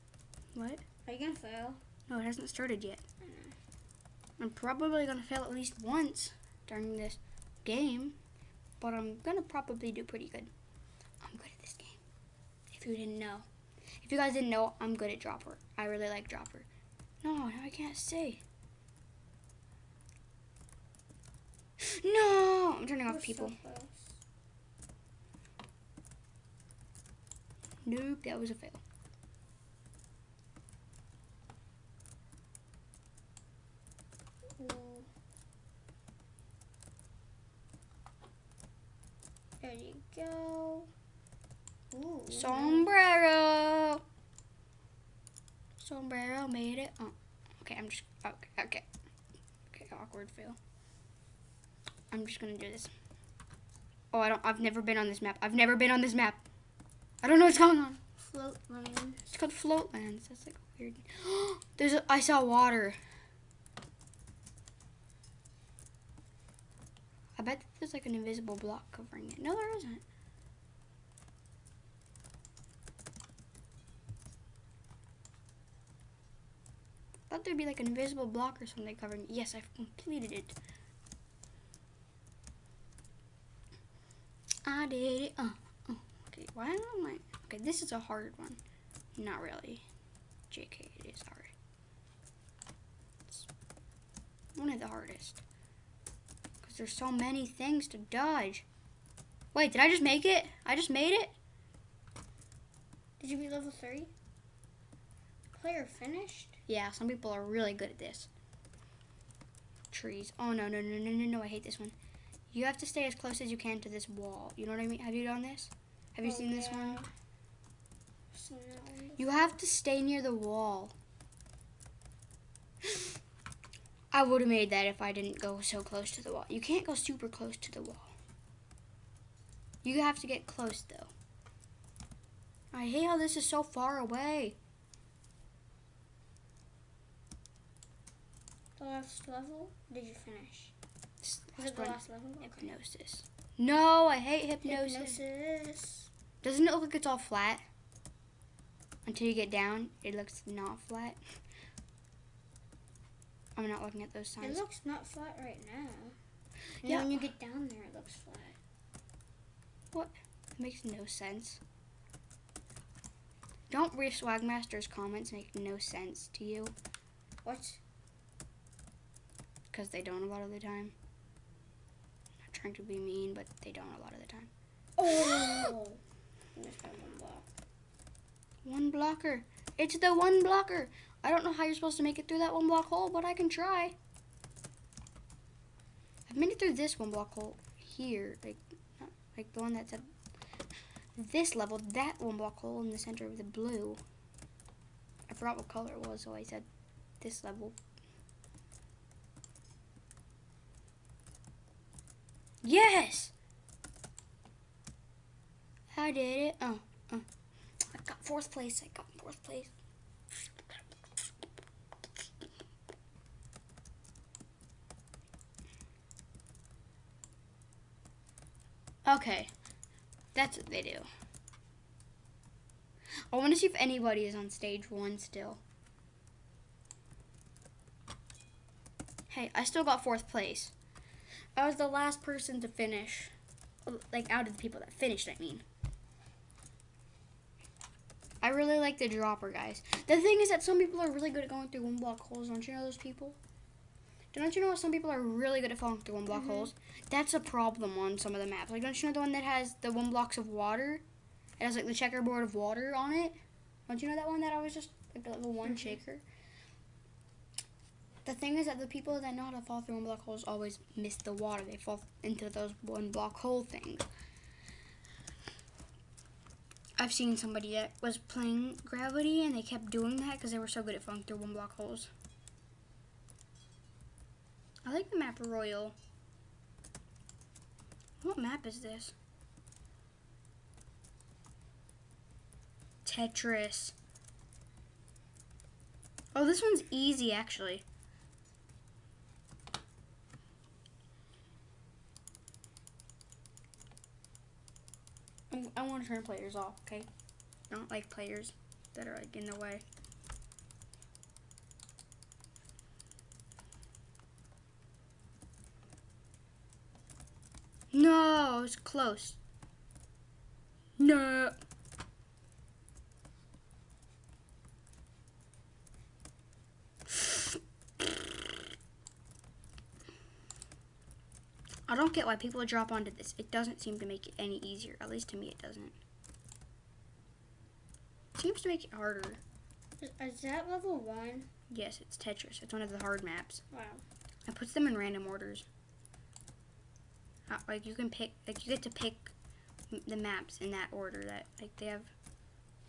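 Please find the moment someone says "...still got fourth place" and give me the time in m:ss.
3:49.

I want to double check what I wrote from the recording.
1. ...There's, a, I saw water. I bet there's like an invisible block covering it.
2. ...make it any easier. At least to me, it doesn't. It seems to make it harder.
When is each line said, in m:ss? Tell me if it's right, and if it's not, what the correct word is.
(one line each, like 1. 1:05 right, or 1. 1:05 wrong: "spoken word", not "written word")
1. 1:01 right
2. 5:24 right.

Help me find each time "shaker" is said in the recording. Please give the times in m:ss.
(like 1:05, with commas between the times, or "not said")
4:15.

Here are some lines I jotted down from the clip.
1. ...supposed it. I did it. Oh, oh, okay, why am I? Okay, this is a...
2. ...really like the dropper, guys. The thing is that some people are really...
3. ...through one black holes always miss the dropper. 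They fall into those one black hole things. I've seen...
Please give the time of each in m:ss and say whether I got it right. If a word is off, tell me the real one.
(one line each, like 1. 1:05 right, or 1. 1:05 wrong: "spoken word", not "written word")
1. 1:19 wrong: "completed", not "supposed"
2. 3:58 right
3. 4:19 wrong: "water", not "dropper".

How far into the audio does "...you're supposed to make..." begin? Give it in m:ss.
3:01.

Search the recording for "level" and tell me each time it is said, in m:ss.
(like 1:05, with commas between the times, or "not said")
1:43, 2:19, 3:11, 3:17, 5:30.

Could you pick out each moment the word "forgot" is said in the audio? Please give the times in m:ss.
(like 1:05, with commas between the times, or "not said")
3:15.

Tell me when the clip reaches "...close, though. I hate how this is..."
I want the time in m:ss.
2:10.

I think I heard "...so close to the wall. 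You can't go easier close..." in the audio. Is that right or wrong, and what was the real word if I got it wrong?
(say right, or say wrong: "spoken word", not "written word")
wrong: "super", not "easier".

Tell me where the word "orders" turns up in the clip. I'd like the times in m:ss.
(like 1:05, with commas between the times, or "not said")
5:35, 5:40.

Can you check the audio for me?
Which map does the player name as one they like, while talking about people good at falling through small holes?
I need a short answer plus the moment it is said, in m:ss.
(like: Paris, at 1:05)
Royal, at 4:35.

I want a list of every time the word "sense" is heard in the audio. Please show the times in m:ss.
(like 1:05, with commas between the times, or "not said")
2:41, 2:45.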